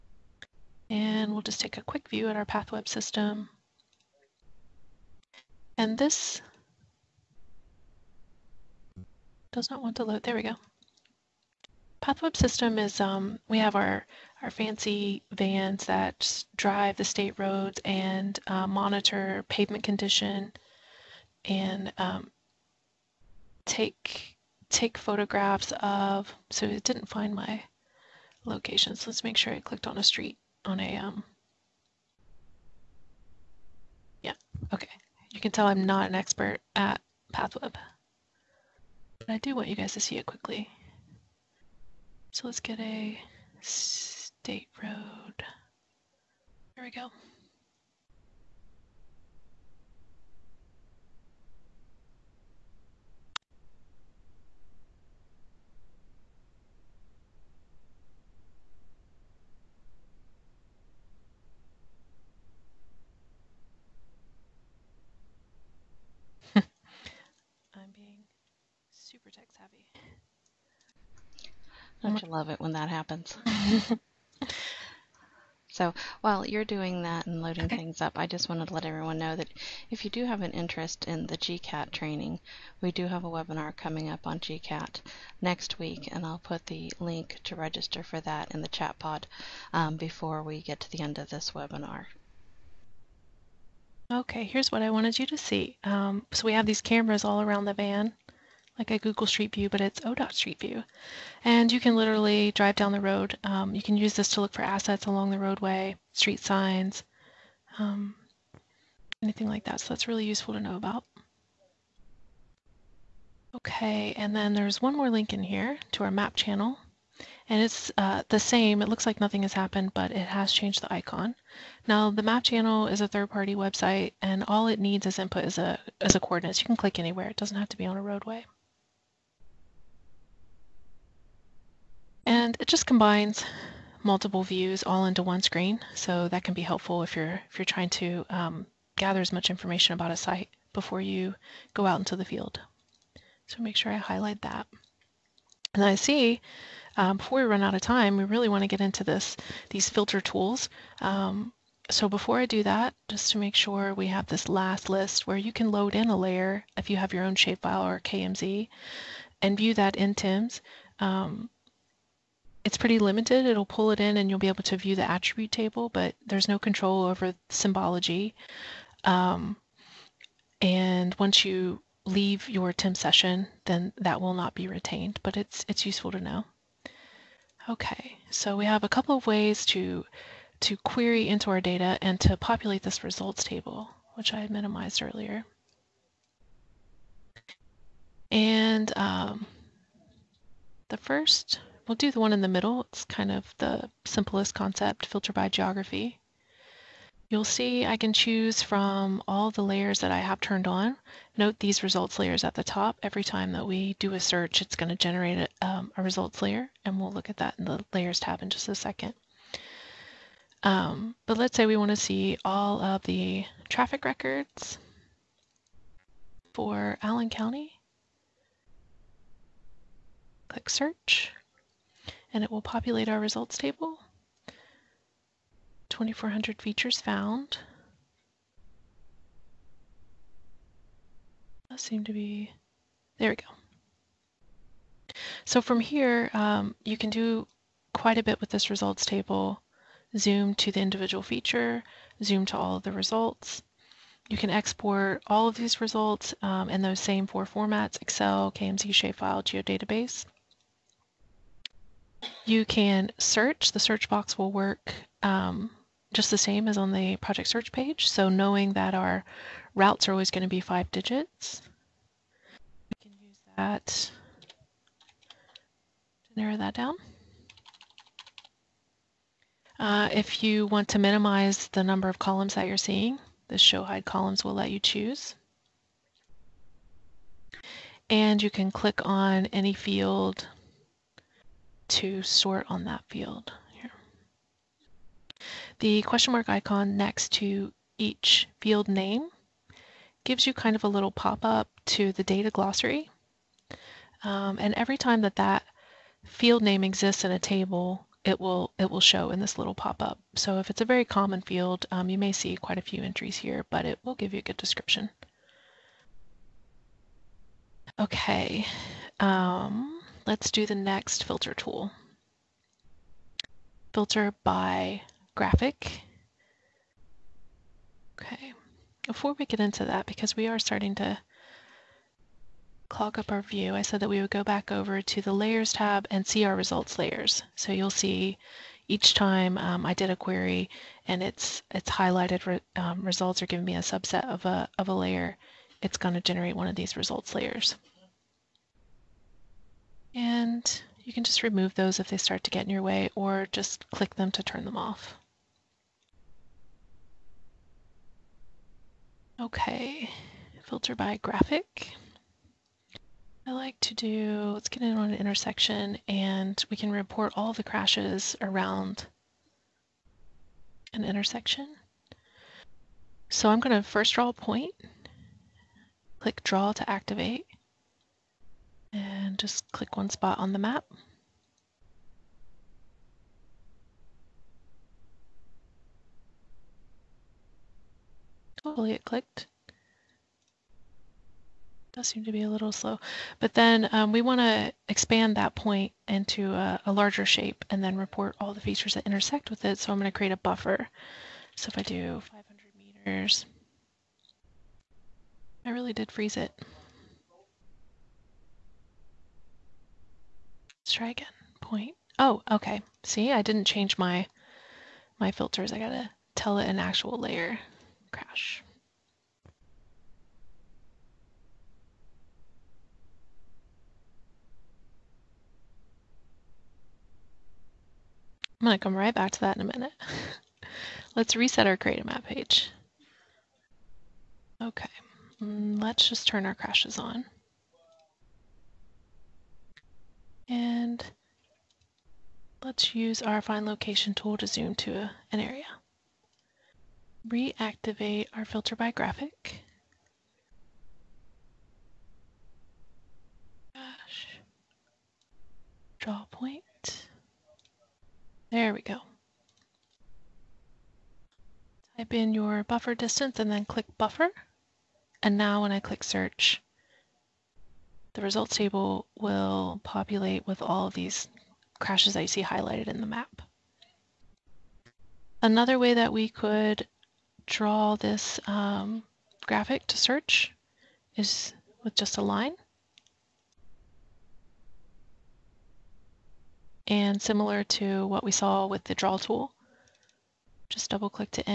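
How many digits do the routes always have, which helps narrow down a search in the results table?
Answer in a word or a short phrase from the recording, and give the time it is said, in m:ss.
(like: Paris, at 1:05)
5, at 4:20.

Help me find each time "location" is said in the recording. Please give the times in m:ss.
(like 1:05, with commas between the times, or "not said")
0:28, 7:13.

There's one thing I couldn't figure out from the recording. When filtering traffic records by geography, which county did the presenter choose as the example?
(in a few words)
Allen County.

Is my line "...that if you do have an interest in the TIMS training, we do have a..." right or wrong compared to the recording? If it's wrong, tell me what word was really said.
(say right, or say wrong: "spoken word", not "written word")
wrong: "GCAT", not "TIMS".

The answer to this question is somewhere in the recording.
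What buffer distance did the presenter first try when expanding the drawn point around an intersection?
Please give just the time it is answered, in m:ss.
6:32.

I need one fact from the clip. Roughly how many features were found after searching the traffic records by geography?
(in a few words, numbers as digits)
2400.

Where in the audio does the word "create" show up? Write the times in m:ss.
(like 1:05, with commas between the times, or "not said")
6:30, 7:01.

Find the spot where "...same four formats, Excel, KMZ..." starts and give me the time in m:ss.
4:07.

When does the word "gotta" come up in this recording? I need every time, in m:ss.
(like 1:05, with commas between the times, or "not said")
6:45.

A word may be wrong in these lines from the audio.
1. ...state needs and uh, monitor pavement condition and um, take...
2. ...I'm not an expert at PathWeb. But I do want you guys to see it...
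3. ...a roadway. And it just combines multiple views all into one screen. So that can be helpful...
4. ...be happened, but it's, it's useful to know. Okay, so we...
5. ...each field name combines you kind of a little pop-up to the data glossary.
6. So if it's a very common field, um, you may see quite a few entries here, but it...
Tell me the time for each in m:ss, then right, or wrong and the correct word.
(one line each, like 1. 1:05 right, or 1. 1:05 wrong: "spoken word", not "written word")
1. 0:17 wrong: "roads", not "needs"
2. 0:35 right
3. 2:07 right
4. 2:54 wrong: "retained", not "happened"
5. 4:47 wrong: "gives", not "combines"
6. 5:00 right.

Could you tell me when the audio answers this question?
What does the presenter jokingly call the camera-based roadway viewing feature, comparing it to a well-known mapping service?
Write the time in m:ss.
1:40.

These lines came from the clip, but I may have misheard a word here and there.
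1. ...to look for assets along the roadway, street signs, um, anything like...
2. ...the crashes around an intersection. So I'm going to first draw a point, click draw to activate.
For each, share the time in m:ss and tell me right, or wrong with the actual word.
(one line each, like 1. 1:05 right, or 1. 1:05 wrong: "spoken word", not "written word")
1. 1:44 right
2. 5:57 right.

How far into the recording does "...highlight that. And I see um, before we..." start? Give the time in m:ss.
2:23.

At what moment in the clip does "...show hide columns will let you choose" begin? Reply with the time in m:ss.
4:33.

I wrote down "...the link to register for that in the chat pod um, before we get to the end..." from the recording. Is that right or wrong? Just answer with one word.
right.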